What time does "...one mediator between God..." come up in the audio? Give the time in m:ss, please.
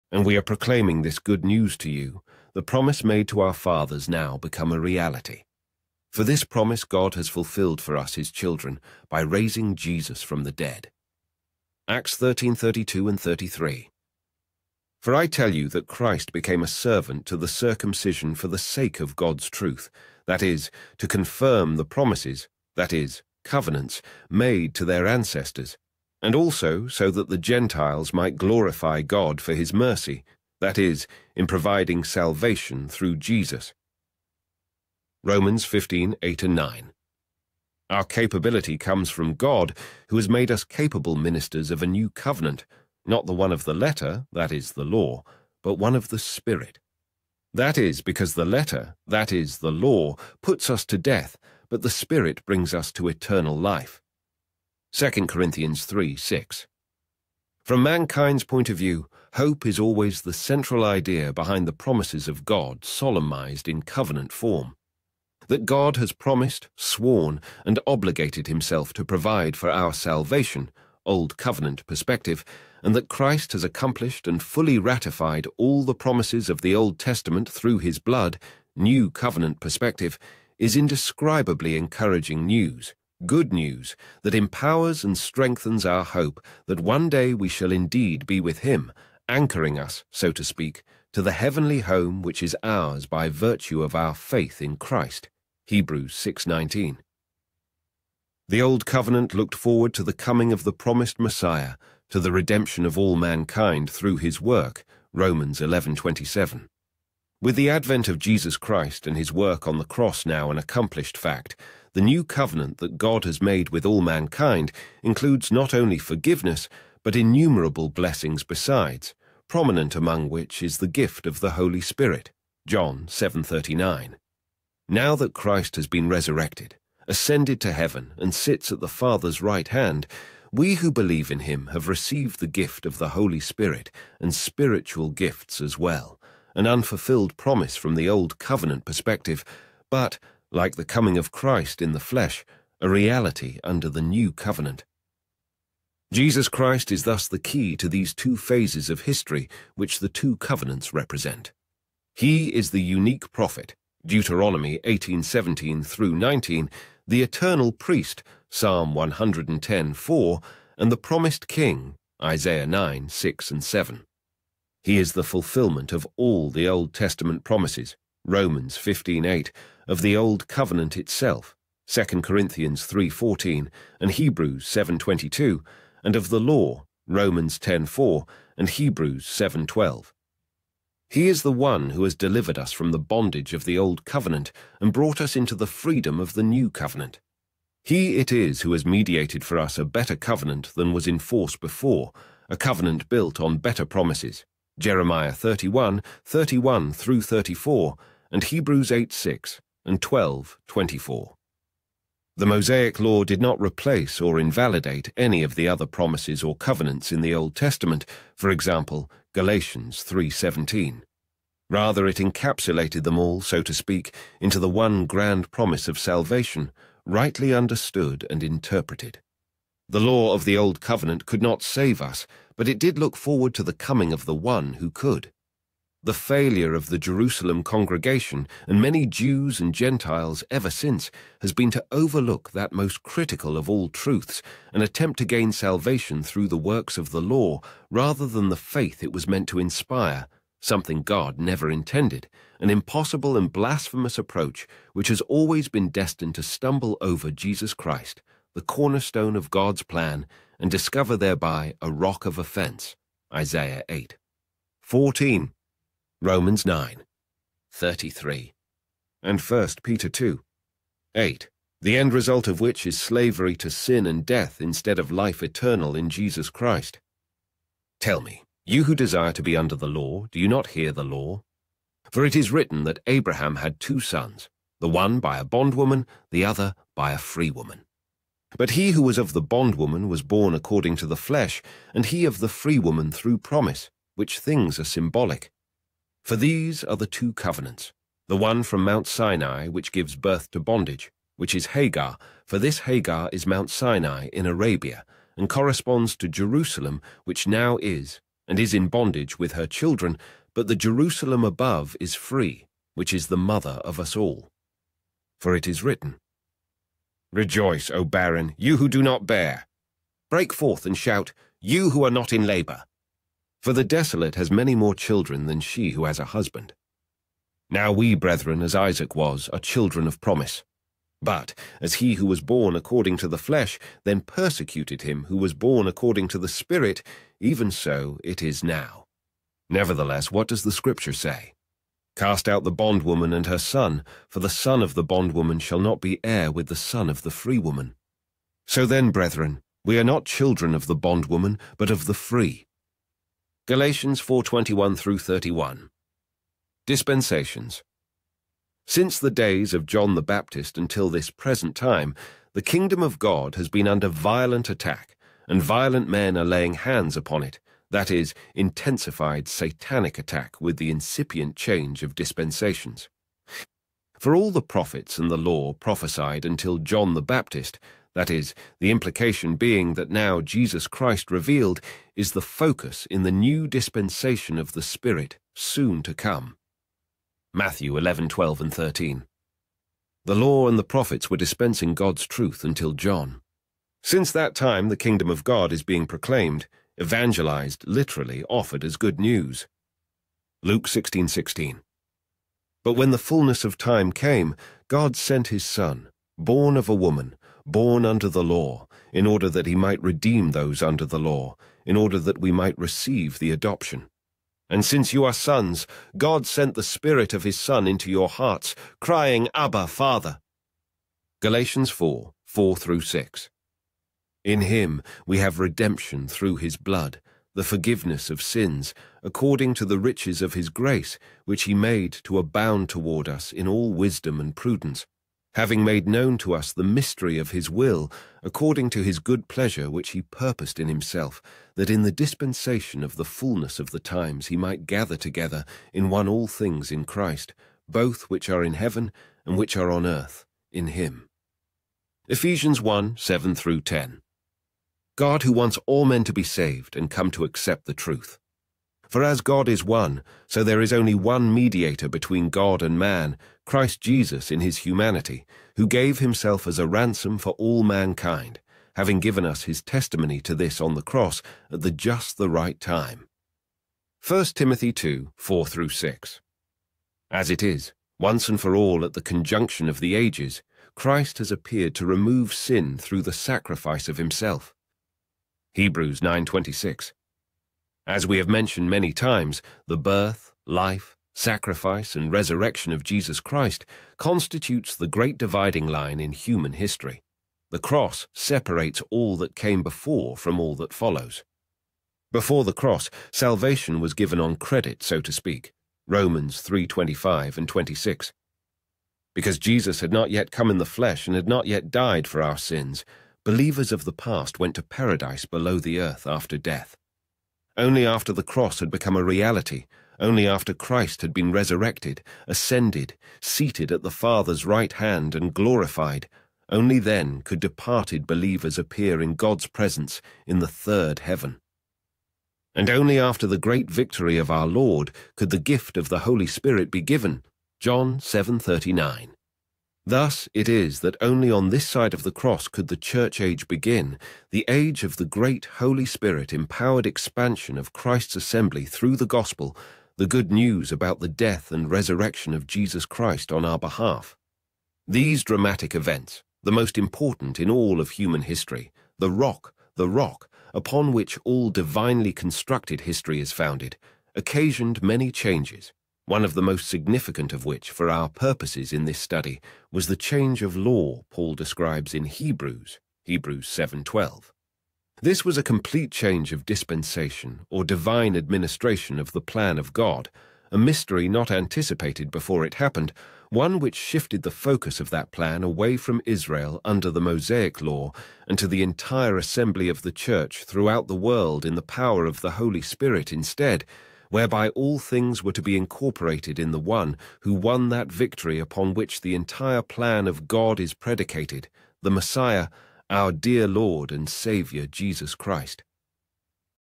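7:31.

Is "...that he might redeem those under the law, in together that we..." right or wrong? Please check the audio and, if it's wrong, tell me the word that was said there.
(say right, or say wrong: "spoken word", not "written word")
wrong: "order", not "together".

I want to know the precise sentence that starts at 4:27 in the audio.
Tell me, you who desire to be under the law, do you not hear the law?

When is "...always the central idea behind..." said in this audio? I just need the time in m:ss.
0:59.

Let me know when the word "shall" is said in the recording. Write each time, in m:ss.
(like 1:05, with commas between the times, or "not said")
1:27, 5:35.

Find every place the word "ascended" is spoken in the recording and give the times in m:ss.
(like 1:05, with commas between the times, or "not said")
2:07, 8:32.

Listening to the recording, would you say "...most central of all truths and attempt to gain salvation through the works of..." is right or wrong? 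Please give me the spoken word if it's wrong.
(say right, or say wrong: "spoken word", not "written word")
wrong: "critical", not "central".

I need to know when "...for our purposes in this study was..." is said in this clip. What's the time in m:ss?
9:17.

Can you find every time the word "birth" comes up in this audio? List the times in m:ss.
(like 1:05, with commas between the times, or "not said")
4:50, 7:59.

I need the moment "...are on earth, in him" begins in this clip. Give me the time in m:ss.
7:19.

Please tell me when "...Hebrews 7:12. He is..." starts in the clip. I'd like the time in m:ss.
2:58.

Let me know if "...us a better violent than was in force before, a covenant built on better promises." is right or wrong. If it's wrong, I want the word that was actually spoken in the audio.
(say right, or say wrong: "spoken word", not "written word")
wrong: "covenant", not "violent".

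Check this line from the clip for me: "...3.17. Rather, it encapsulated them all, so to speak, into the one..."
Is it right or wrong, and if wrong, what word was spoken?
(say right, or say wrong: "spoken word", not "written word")
right.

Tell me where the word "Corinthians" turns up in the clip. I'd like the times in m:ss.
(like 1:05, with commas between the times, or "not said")
0:55, 2:52.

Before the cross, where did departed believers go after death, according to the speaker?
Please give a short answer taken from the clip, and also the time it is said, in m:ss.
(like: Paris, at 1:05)
Paradise below the earth, at 8:24.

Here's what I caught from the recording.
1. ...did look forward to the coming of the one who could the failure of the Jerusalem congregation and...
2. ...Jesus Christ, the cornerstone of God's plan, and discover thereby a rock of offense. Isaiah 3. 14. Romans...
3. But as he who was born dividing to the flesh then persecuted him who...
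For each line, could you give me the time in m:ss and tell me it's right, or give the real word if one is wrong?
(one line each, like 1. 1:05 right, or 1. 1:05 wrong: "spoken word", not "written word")
1. 3:42 right
2. 4:07 wrong: "8", not "3"
3. 5:21 wrong: "according", not "dividing".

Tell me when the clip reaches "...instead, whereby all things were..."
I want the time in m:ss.
9:43.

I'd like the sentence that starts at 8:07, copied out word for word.
The cross separates all that came before from all that follows.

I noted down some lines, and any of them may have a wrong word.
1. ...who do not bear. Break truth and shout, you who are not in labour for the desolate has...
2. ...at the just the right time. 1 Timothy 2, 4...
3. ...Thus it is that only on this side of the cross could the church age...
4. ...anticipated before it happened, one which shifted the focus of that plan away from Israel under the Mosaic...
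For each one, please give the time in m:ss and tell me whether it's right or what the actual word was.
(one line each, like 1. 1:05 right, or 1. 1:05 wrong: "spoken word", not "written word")
1. 5:08 wrong: "forth", not "truth"
2. 7:41 right
3. 8:50 right
4. 9:31 right.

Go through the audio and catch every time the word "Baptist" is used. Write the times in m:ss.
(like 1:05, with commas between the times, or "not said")
5:50, 6:07.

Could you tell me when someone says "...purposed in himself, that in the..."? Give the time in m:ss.
7:10.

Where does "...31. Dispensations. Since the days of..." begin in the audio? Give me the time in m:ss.
5:45.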